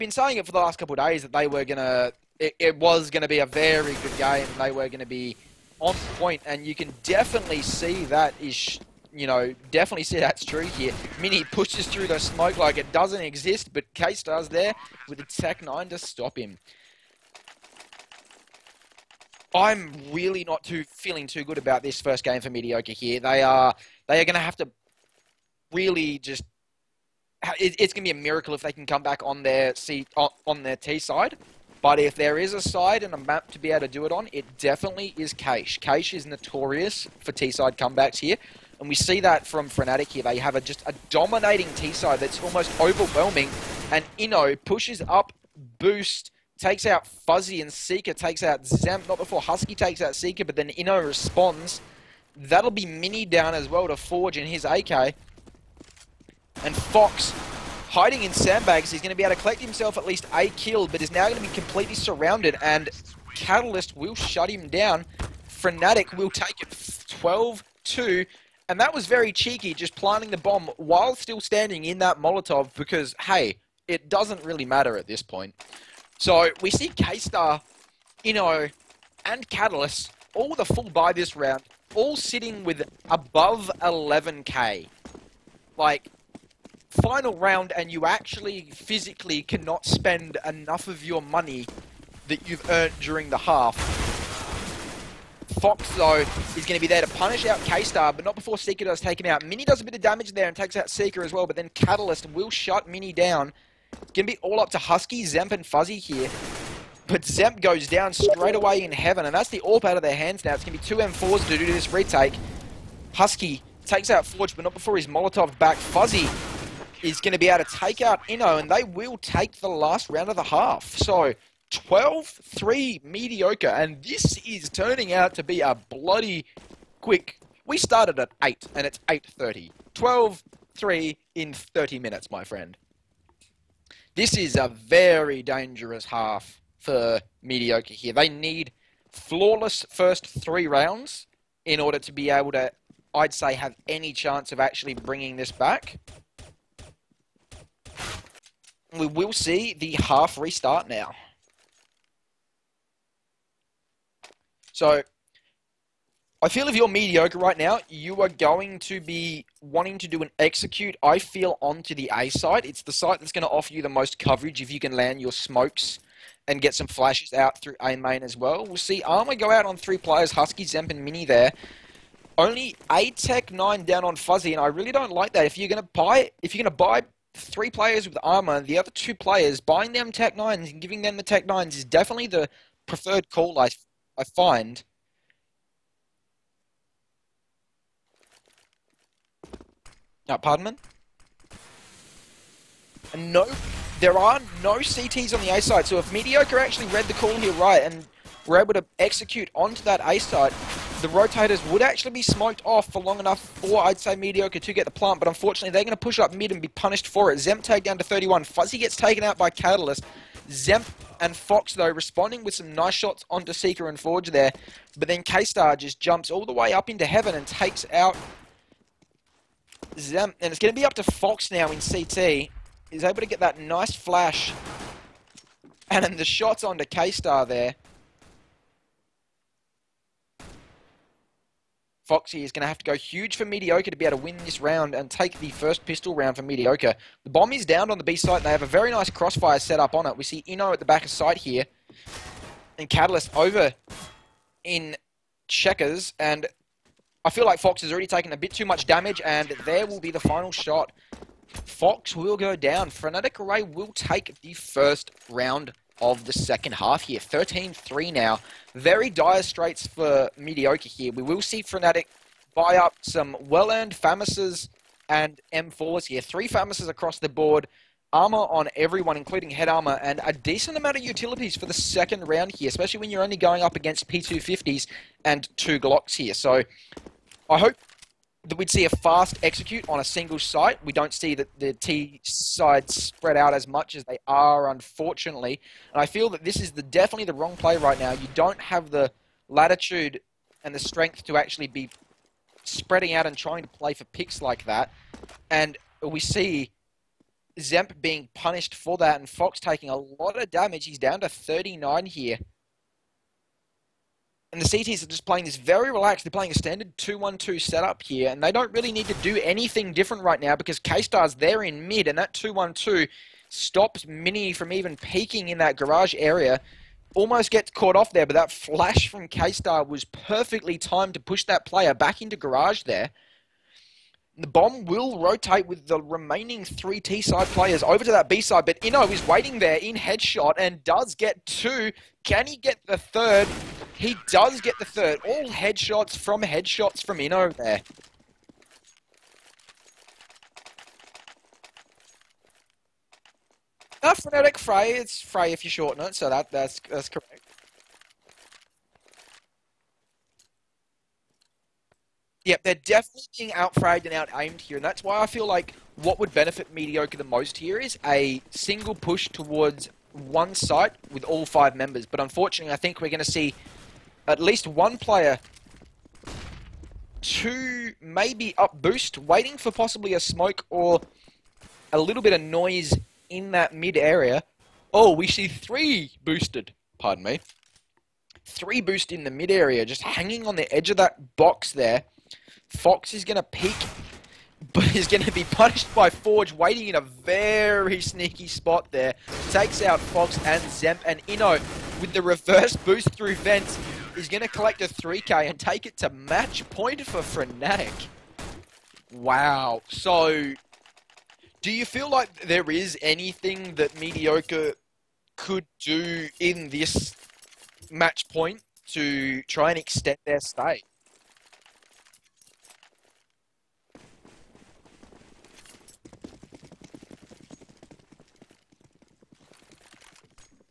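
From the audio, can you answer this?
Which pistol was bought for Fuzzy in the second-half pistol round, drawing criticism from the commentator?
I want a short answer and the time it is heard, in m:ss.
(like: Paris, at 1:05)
Tech 9, at 2:53.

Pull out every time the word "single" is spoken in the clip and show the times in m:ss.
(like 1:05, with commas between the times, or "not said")
4:40, 5:58.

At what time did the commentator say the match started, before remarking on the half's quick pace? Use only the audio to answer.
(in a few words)
8.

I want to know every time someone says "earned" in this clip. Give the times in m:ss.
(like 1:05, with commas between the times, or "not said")
1:32, 4:23.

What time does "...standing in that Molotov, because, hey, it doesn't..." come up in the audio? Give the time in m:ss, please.
1:11.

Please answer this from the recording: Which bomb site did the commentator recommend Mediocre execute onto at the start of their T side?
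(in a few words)
A site.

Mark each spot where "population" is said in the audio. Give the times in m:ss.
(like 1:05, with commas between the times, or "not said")
not said.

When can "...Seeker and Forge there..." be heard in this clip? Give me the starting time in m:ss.
3:33.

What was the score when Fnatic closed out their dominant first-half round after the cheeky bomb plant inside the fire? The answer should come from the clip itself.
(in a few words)
12-2.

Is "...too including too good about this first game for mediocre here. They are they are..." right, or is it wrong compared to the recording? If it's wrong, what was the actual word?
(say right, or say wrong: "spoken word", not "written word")
wrong: "feeling", not "including".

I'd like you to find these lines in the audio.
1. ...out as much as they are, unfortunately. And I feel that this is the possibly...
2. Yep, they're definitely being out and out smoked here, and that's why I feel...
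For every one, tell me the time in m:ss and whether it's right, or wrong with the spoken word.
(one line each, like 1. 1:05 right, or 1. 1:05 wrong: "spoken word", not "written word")
1. 4:43 wrong: "definitely", not "possibly"
2. 5:52 wrong: "aimed", not "smoked".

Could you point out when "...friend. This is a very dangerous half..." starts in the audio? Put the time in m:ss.
2:12.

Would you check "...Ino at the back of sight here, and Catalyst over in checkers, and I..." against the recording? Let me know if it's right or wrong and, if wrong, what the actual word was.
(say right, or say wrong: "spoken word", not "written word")
right.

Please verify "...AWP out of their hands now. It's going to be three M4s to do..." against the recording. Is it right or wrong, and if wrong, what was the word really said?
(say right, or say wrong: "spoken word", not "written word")
wrong: "two", not "three".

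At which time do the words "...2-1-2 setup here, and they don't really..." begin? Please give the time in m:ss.
5:06.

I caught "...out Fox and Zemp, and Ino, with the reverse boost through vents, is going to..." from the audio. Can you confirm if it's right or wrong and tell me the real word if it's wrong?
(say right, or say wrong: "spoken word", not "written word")
right.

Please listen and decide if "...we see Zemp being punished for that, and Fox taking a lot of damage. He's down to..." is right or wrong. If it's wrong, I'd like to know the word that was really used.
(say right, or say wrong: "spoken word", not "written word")
right.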